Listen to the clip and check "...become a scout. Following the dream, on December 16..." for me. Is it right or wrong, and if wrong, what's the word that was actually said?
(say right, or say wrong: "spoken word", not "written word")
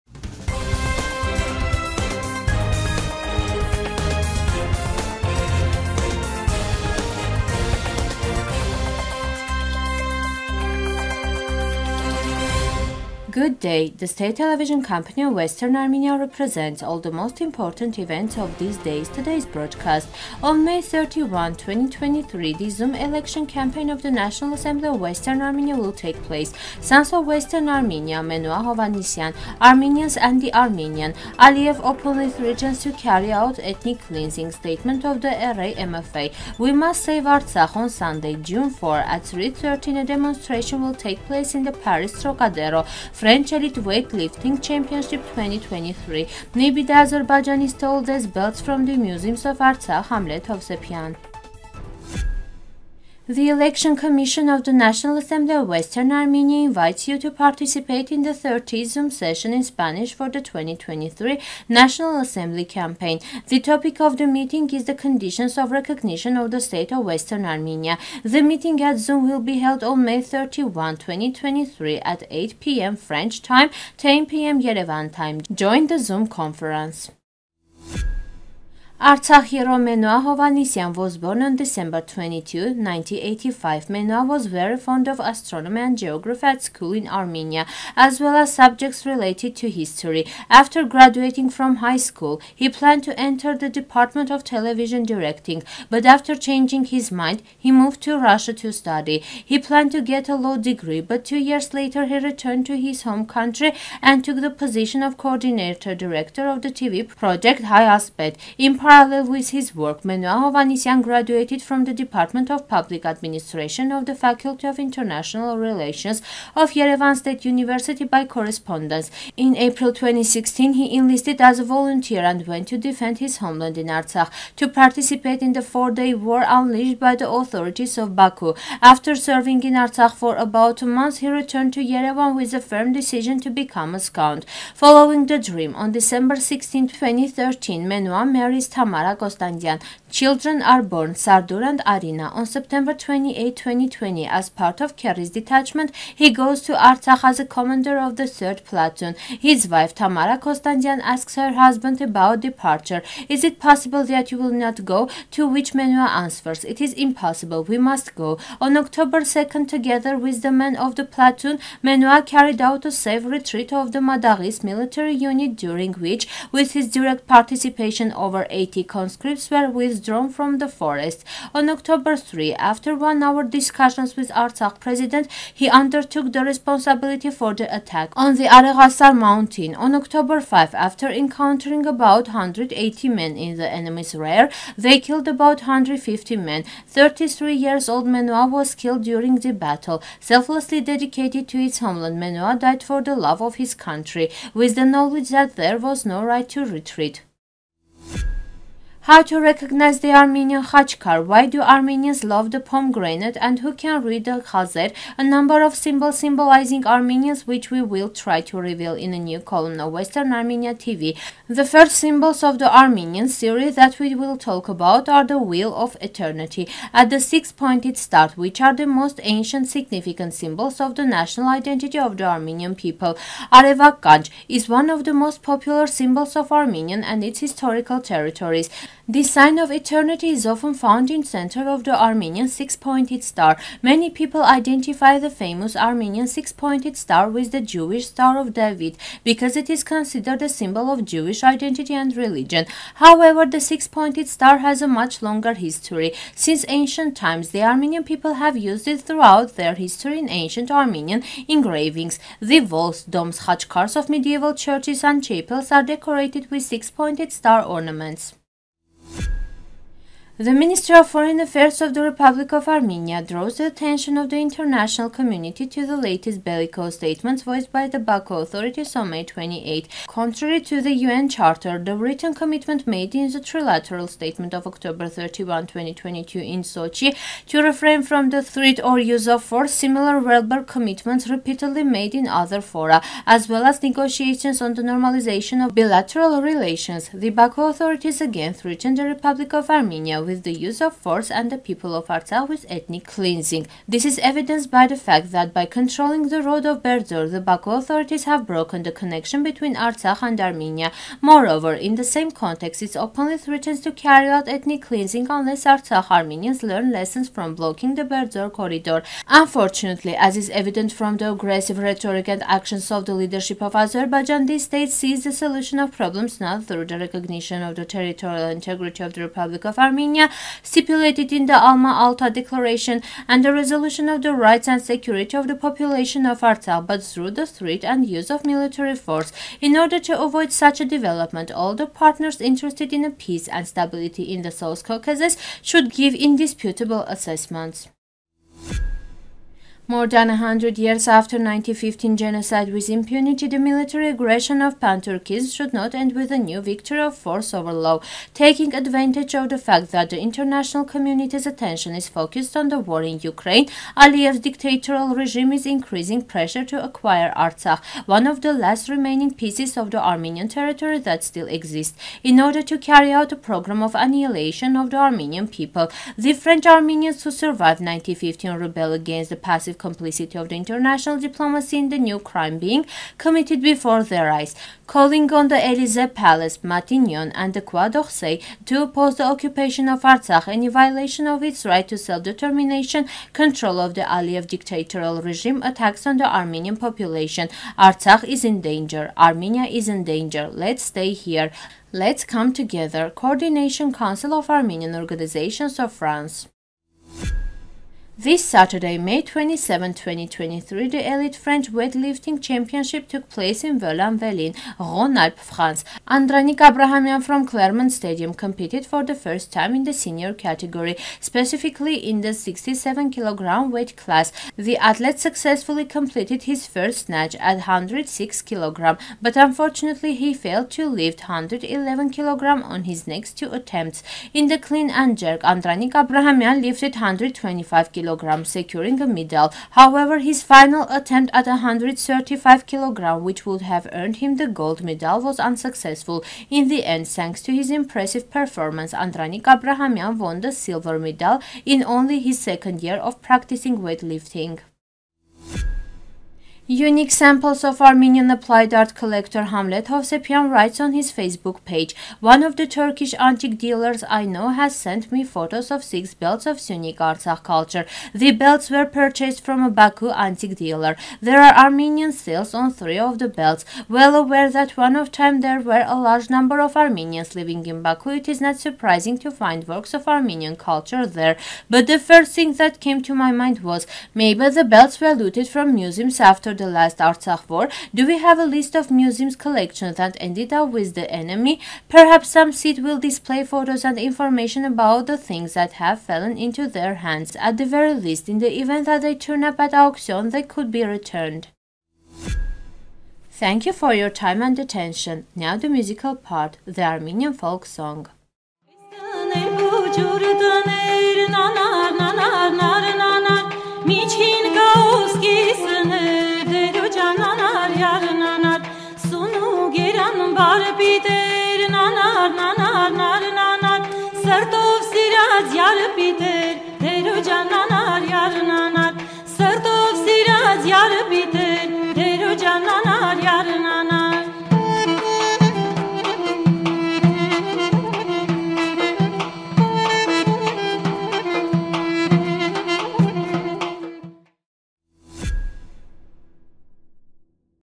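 right.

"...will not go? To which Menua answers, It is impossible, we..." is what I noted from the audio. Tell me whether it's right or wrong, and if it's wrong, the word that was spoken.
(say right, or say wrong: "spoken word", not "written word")
right.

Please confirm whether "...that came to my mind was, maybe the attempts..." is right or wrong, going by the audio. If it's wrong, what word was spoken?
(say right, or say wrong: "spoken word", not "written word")
wrong: "belts", not "attempts".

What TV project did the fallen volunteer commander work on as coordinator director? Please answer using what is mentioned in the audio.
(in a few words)
High Aspect.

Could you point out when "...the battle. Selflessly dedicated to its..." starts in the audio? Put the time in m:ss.
3:09.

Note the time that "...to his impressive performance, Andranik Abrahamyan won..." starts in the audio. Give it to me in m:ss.
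7:17.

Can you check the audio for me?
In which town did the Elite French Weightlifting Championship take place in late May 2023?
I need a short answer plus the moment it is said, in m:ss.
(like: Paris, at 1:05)
Vaulx-en-Velin, at 6:43.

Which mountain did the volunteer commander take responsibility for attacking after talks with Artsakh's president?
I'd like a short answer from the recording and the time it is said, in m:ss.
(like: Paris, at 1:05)
Areghasar, at 2:58.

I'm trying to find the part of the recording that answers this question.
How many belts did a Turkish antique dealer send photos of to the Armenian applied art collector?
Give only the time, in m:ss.
7:35.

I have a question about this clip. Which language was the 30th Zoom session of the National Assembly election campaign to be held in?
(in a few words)
Spanish.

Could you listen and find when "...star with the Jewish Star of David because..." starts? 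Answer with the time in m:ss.
3:56.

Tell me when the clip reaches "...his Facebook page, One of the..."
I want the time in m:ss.
7:30.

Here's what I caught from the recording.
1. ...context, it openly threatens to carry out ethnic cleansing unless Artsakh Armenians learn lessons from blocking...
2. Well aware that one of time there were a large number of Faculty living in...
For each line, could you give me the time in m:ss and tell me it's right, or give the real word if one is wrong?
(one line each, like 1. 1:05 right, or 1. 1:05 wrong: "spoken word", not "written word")
1. 5:02 right
2. 7:43 wrong: "Armenians", not "Faculty".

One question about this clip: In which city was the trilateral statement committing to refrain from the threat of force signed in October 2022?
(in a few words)
Sochi.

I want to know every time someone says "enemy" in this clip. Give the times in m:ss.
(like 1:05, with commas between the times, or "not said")
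3:03, 8:01.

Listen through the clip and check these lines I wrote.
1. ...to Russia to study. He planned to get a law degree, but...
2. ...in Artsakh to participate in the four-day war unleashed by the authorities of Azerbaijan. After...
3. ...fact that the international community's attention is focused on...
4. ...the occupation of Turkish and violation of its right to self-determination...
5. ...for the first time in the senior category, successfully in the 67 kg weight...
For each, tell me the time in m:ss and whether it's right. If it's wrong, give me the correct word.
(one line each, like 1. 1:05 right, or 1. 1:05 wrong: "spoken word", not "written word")
1. 1:38 right
2. 2:03 wrong: "Baku", not "Azerbaijan"
3. 5:49 right
4. 6:19 wrong: "Artsakh", not "Turkish"
5. 6:48 wrong: "specifically", not "successfully".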